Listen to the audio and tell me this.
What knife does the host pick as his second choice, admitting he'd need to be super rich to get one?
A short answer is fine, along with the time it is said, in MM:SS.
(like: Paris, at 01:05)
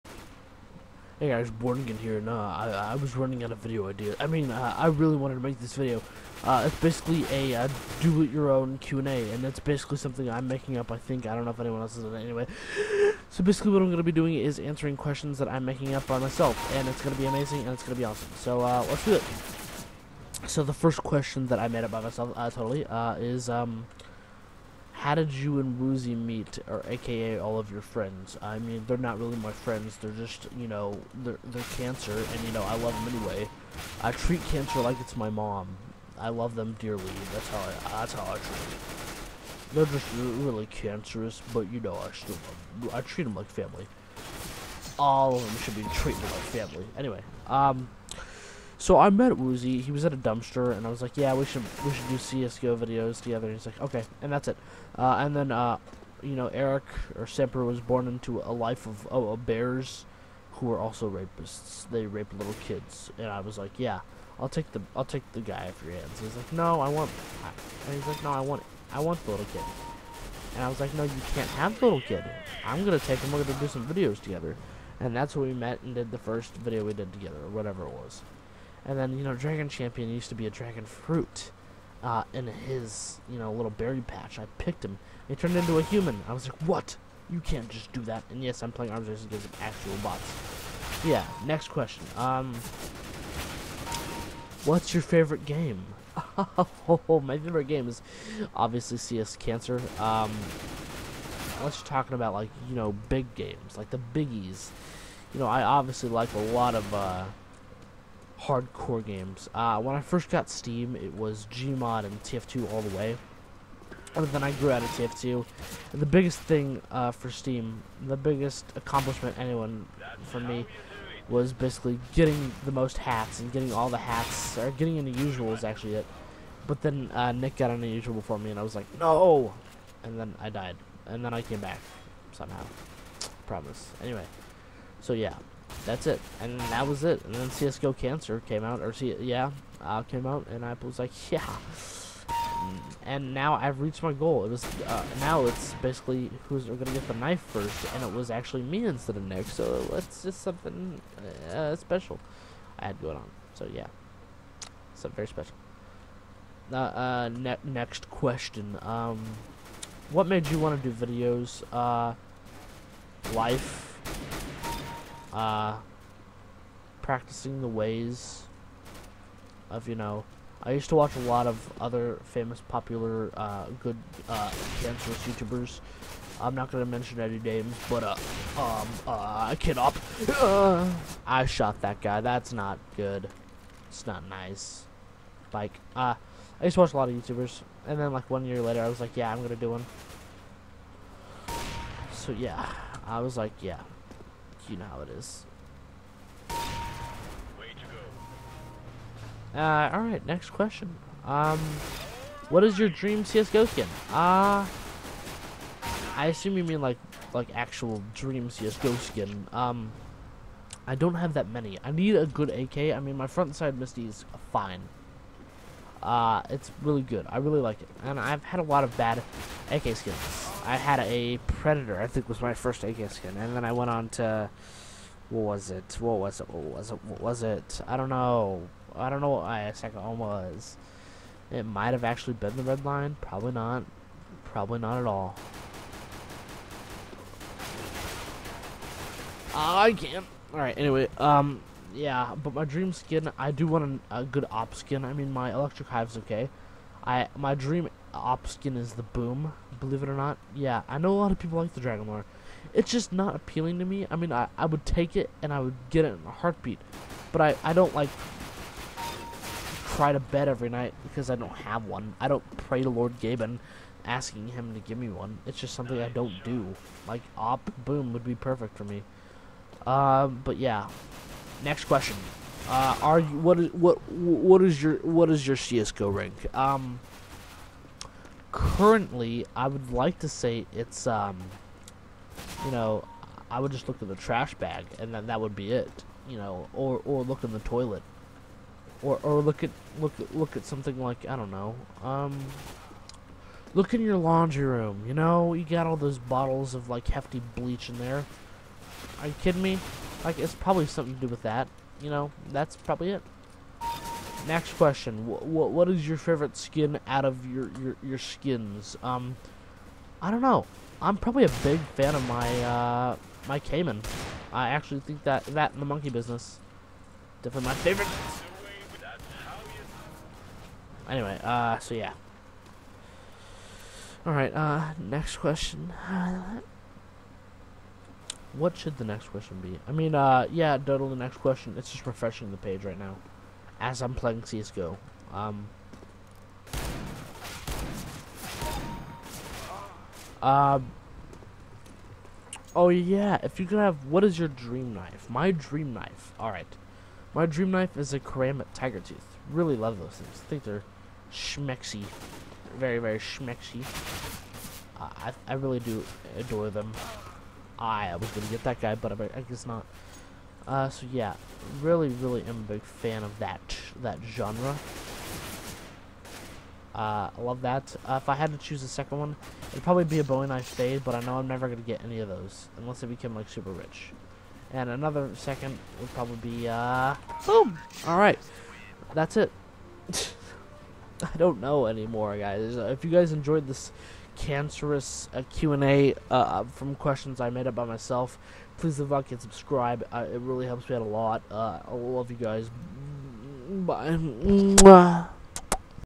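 Bowie knife fade, at 06:10.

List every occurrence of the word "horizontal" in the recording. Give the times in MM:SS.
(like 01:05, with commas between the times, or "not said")
not said.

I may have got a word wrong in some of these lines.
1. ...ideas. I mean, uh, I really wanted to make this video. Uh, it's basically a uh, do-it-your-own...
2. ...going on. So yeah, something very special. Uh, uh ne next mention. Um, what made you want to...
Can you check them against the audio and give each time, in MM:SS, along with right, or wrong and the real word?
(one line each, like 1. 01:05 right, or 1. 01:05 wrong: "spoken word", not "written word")
1. 00:03 right
2. 02:33 wrong: "question", not "mention".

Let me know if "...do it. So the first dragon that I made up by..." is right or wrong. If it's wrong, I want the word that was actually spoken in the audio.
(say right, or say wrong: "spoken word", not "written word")
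wrong: "question", not "dragon".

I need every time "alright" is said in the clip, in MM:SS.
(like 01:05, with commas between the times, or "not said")
03:19, 04:00, 05:24, 05:46.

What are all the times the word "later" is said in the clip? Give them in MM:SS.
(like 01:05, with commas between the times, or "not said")
03:08.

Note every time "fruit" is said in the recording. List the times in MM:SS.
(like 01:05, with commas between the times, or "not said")
01:20.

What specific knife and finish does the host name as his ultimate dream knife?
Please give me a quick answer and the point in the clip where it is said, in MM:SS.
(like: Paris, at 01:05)
Ceramic Tiger Tooth, at 05:48.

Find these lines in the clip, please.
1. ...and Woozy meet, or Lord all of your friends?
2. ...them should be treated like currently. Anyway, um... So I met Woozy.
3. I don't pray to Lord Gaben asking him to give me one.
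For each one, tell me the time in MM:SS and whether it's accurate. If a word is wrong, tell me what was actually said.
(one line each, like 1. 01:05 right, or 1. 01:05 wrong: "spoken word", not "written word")
1. 00:25 wrong: "AKA", not "Lord"
2. 00:45 wrong: "family", not "currently"
3. 04:22 right.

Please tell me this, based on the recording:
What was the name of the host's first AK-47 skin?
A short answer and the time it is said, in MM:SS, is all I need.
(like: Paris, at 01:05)
Predator, at 03:41.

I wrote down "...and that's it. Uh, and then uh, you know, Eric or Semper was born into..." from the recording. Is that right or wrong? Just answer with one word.
right.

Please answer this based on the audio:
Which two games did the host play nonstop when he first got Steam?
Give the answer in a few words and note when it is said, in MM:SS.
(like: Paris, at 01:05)
Gmod and TF2, at 01:51.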